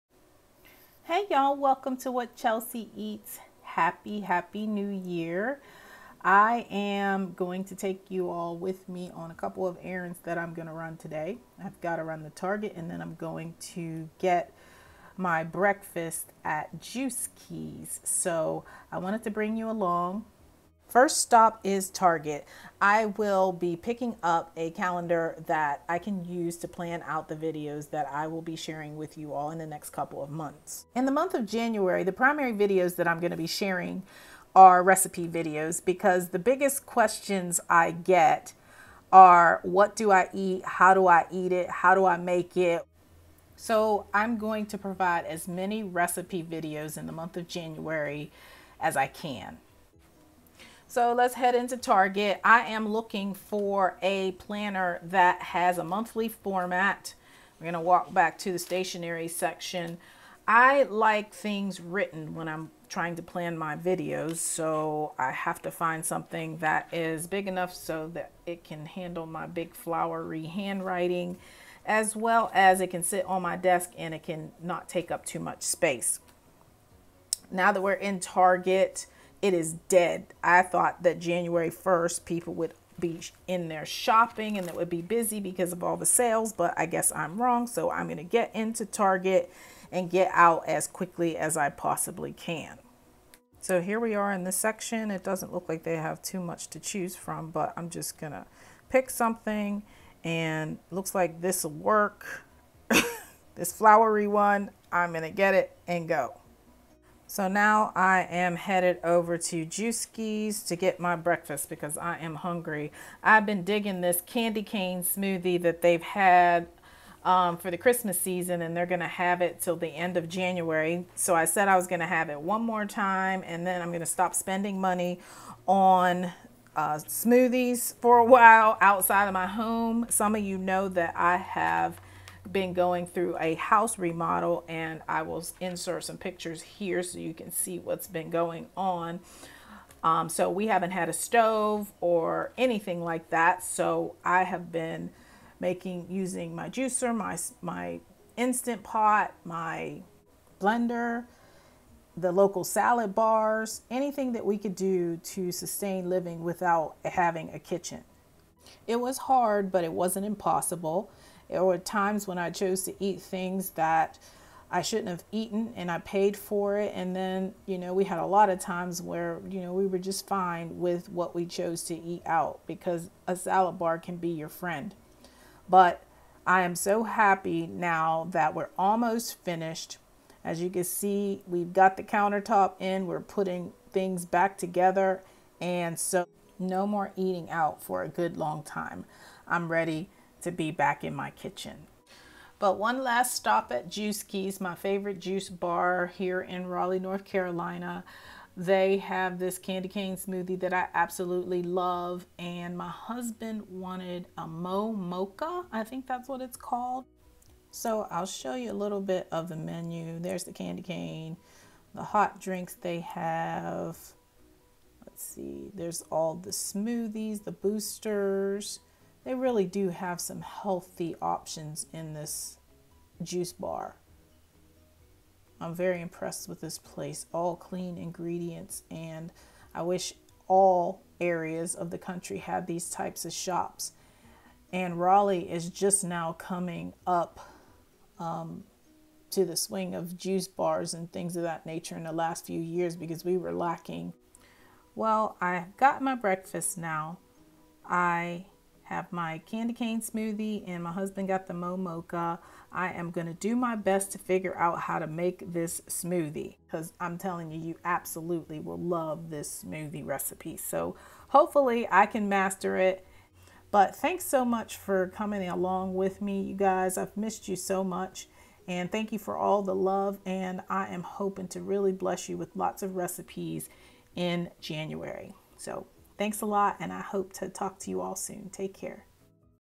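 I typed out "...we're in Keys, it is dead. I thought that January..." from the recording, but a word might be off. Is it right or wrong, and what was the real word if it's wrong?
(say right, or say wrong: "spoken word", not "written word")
wrong: "Target", not "Keys".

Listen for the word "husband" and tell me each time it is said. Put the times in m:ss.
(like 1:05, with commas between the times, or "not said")
3:22, 4:10.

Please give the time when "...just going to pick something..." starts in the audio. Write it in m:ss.
1:37.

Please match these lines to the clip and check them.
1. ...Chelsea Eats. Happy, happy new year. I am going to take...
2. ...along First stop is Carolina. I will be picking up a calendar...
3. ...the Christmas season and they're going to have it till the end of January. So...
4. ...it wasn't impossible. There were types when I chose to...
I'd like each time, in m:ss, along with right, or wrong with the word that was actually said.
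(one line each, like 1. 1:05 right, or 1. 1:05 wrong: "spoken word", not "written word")
1. 0:02 right
2. 0:19 wrong: "Target", not "Carolina"
3. 1:57 right
4. 2:39 wrong: "times", not "types".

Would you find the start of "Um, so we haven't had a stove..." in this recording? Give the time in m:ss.
2:20.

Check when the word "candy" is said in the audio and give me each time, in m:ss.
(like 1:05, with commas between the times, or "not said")
1:54, 3:19, 3:30, 4:09.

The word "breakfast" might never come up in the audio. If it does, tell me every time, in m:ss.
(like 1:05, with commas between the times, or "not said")
0:15, 1:51, 4:06.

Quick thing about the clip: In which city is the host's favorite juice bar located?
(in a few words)
Raleigh, North Carolina.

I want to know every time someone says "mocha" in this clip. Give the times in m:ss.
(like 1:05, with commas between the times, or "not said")
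3:24, 4:11.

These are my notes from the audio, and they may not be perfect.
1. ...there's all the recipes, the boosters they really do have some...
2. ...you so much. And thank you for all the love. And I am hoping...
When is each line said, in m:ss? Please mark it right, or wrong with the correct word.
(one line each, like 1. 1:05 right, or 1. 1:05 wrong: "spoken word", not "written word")
1. 3:35 wrong: "smoothies", not "recipes"
2. 4:27 right.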